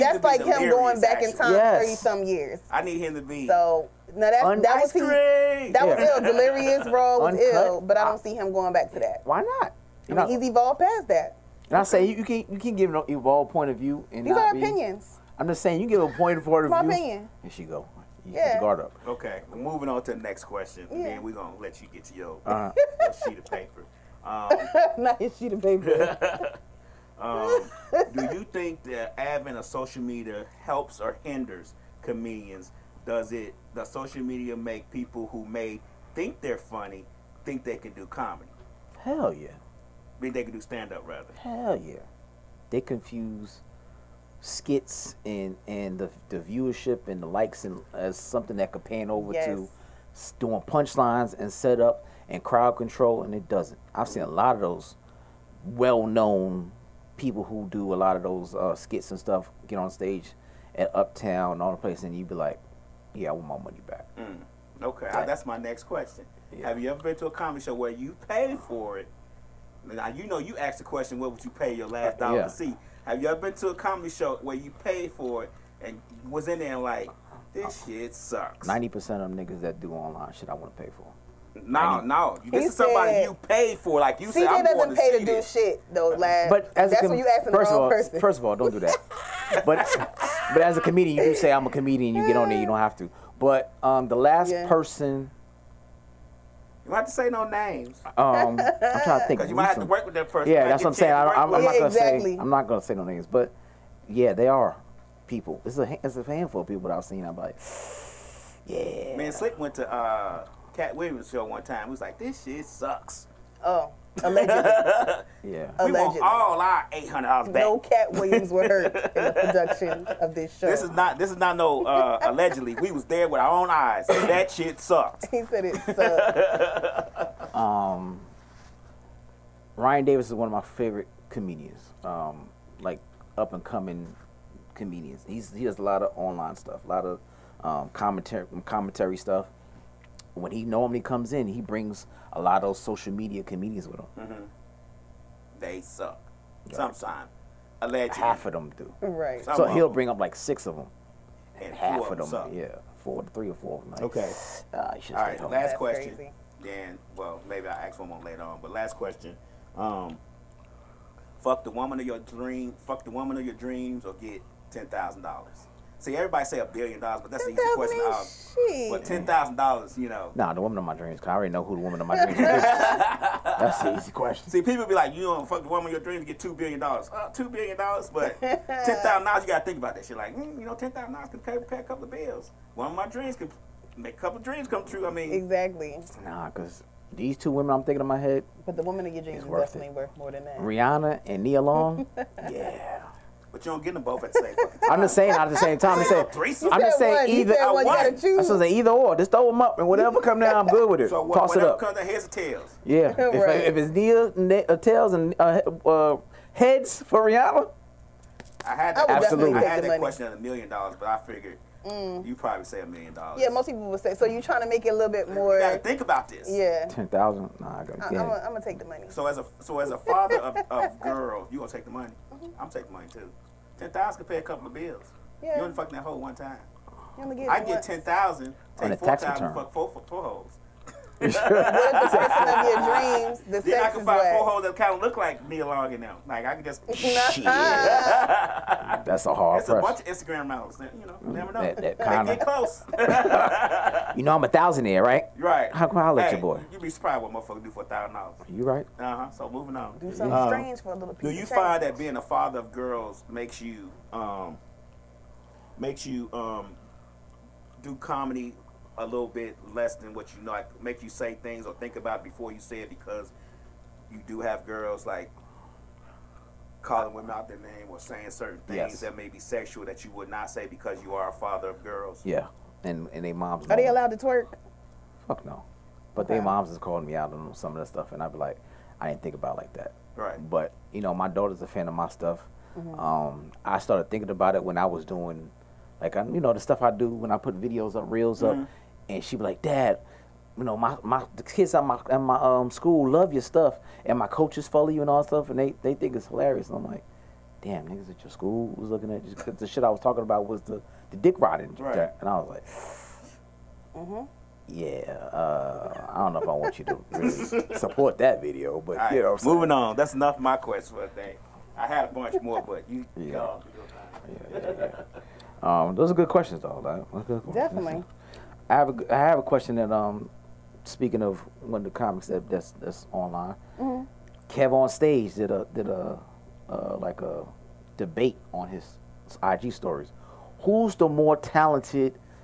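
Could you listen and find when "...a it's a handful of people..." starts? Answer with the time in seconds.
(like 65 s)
105 s.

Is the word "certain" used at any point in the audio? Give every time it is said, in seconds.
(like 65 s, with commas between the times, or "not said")
268 s.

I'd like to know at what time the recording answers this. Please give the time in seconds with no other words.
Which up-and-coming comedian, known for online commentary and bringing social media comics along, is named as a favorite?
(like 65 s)
129 s.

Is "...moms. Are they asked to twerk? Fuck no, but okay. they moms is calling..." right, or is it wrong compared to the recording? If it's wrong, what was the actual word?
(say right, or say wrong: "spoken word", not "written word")
wrong: "allowed", not "asked".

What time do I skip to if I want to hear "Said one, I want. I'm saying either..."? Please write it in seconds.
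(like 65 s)
197 s.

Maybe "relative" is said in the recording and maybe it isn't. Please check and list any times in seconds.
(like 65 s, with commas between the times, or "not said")
not said.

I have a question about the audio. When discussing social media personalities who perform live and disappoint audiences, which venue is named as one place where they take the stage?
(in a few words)
Uptown.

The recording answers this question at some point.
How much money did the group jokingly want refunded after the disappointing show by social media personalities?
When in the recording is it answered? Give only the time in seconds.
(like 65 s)
116 s.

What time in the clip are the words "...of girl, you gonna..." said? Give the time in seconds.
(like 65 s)
220 s.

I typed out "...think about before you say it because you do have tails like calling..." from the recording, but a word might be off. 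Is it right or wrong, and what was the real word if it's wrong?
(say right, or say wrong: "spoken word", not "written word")
wrong: "girls", not "tails".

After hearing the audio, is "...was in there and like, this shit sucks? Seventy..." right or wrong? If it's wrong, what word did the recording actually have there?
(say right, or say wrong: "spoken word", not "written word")
wrong: "Ninety", not "Seventy".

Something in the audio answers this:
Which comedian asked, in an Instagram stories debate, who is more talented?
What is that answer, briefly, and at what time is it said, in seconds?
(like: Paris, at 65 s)
Kev on stage, at 324 s.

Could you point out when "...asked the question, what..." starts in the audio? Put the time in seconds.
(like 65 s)
70 s.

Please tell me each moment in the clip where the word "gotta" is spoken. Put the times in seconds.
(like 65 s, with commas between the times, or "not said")
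179 s, 215 s.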